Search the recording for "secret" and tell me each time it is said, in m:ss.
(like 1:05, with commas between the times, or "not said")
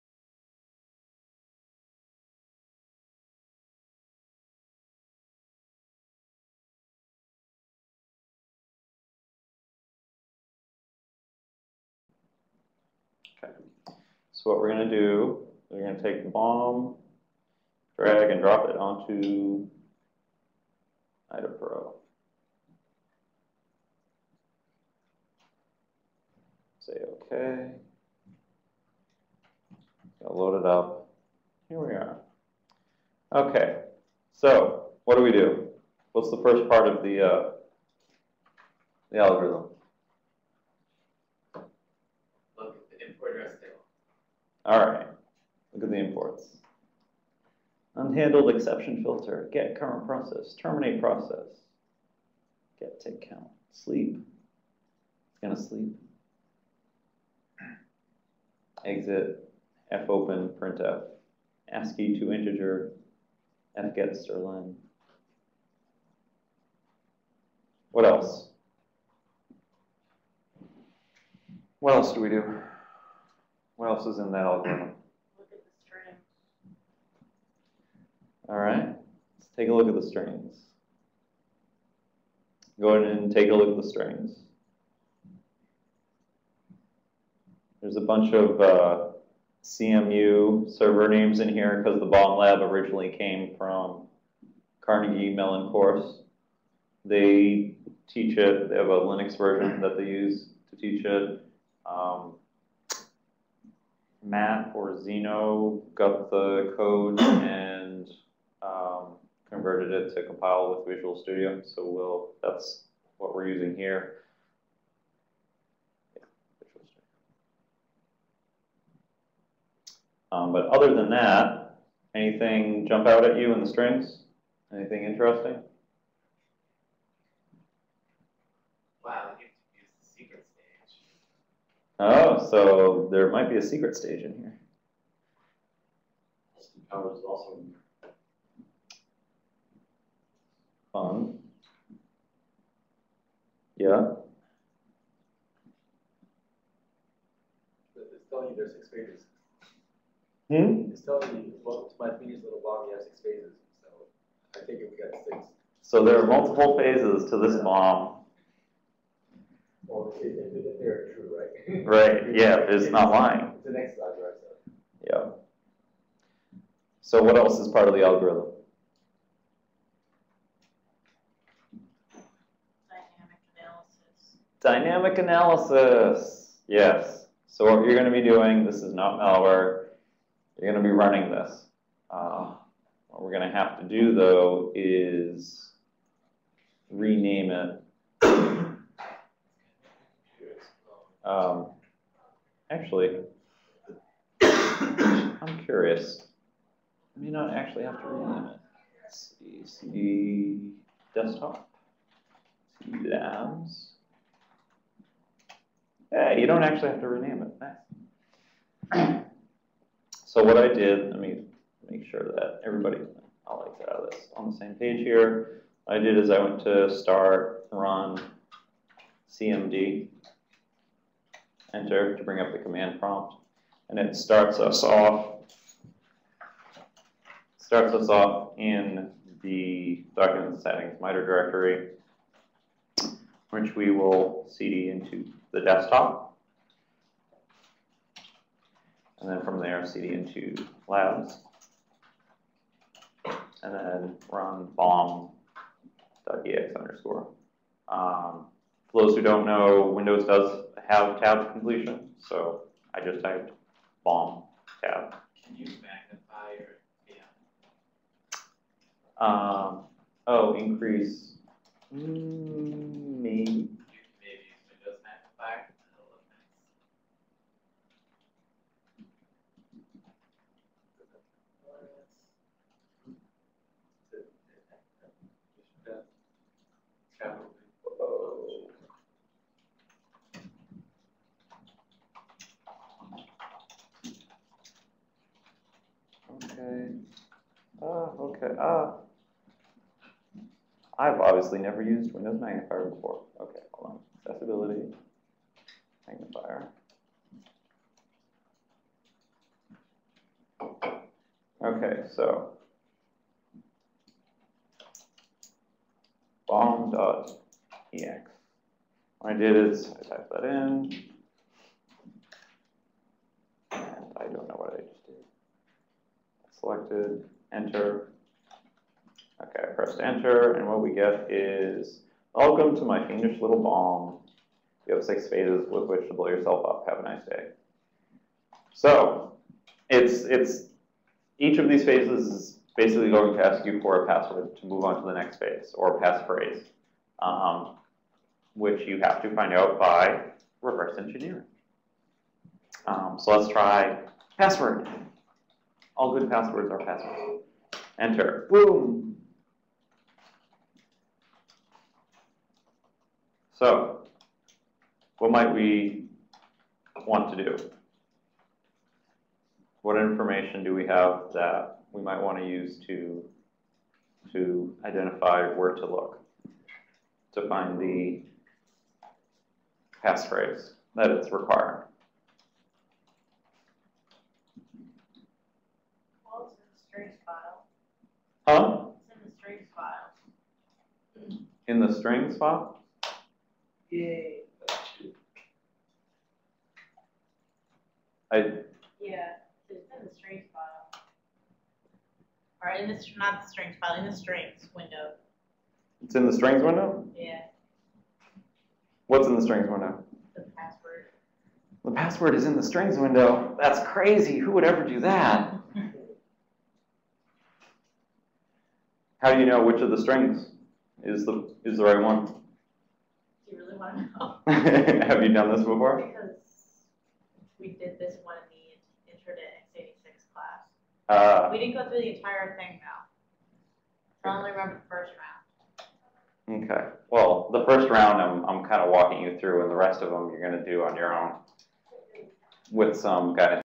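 2:13.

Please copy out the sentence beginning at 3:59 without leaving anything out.
And then from there, cd into labs.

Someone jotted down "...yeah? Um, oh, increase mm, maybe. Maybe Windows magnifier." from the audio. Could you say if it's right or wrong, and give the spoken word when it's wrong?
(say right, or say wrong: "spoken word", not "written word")
right.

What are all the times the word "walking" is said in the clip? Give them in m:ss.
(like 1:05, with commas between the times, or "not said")
7:08.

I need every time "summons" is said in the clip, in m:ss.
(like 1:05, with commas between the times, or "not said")
not said.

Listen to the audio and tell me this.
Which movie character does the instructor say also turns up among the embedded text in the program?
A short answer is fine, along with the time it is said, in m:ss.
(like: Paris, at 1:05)
Austin Powers, at 2:16.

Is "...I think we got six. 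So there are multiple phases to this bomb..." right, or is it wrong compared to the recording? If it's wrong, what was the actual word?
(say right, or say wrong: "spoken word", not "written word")
right.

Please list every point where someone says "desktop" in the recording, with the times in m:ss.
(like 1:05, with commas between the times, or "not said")
3:21, 3:55.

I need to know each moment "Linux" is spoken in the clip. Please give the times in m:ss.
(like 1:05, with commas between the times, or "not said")
1:38.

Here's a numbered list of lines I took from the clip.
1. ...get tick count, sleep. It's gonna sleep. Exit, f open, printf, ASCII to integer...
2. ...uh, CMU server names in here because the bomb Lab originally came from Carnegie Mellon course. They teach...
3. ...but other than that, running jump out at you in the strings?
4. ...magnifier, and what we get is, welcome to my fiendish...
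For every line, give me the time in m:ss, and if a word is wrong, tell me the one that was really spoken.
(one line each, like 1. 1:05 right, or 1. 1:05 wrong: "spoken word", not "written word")
1. 0:52 right
2. 1:28 right
3. 2:00 wrong: "anything", not "running"
4. 5:20 wrong: "enter", not "magnifier".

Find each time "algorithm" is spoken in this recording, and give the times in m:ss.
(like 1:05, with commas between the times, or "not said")
0:39, 1:14, 2:48.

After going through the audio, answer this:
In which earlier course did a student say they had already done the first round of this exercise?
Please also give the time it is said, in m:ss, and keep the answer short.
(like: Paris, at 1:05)
intro x86, at 6:59.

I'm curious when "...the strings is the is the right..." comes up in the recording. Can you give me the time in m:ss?
6:49.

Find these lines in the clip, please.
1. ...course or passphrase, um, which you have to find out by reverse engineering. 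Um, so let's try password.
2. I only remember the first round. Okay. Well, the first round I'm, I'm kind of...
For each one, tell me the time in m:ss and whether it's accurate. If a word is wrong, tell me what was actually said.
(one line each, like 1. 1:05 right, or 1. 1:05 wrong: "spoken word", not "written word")
1. 5:35 wrong: "phase", not "course"
2. 7:04 right.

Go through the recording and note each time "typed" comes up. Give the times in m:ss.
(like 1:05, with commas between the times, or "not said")
4:13, 5:10.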